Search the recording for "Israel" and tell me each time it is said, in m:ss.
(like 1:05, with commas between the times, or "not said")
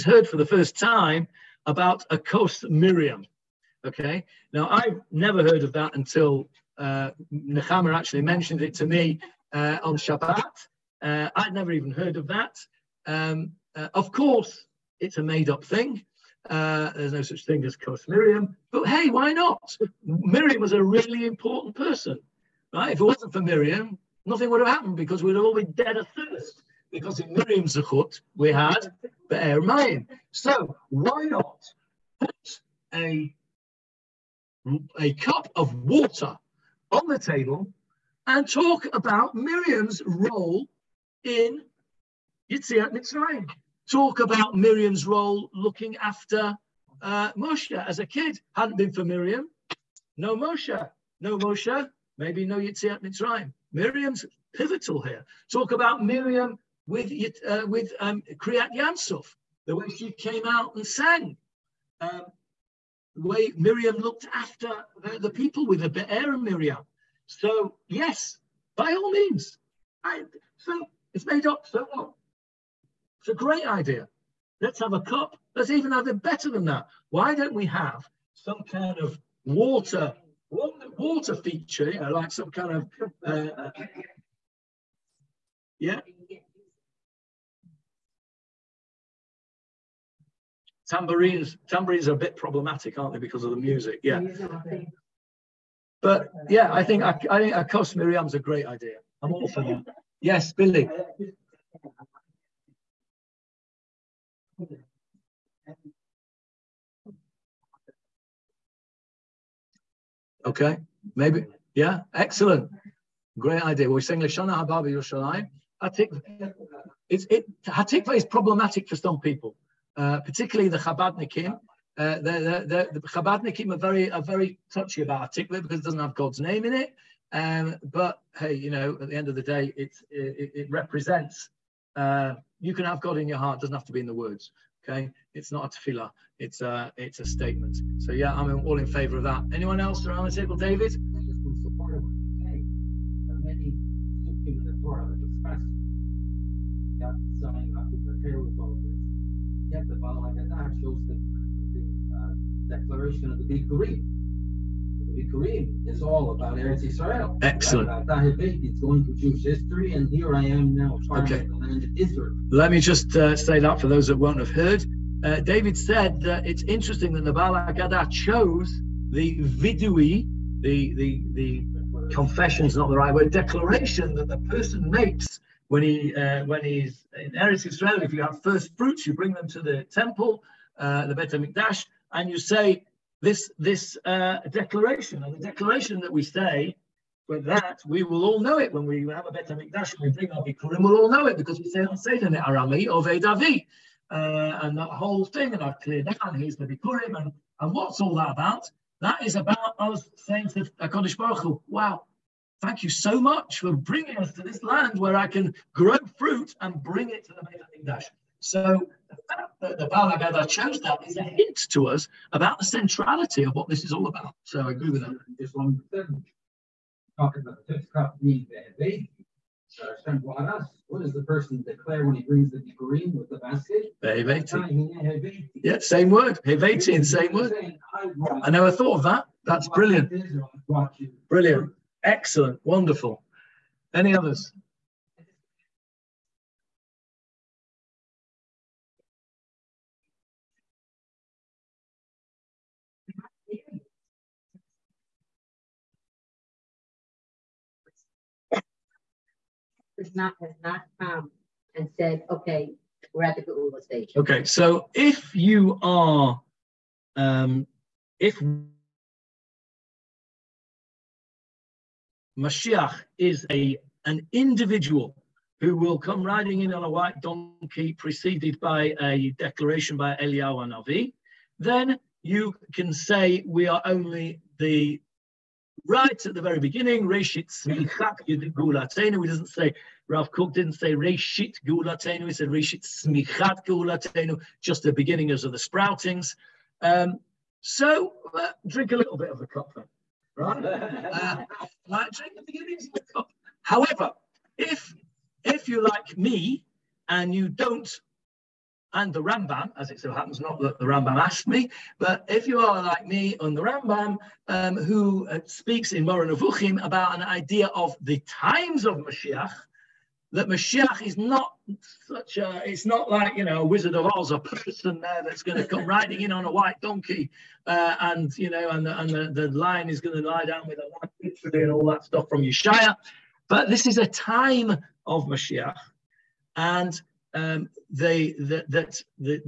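2:36, 2:41, 2:57.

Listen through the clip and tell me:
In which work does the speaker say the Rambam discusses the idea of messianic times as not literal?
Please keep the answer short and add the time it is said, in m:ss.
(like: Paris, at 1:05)
Moreh Nevuchim, at 5:06.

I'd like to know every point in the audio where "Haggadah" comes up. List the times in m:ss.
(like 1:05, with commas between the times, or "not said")
2:30, 2:47, 3:30.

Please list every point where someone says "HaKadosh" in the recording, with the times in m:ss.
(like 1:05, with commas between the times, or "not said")
3:20.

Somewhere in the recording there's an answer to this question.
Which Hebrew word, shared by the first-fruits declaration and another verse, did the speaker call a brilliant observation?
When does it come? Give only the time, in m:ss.
3:46.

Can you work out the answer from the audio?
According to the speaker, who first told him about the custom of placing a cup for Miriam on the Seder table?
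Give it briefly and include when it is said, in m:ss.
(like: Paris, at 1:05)
Nechama, at 0:07.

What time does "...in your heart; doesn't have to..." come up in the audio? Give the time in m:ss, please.
2:13.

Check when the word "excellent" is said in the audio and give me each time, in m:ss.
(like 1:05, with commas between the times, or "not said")
1:52, 2:37, 3:52.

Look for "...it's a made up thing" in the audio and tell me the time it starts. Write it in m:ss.
0:14.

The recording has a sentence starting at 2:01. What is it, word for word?
Uh, the, the, the, the Chabadnikim are very are very touchy about Hatikva because it doesn't have God's name in it.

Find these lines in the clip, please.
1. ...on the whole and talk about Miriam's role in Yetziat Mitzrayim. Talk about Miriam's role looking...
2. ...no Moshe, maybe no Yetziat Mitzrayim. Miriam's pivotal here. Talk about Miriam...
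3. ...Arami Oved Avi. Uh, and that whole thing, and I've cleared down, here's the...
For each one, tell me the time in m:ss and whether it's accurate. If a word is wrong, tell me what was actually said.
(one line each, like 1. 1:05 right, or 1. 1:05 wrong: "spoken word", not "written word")
1. 0:36 wrong: "table", not "whole"
2. 0:51 right
3. 3:12 right.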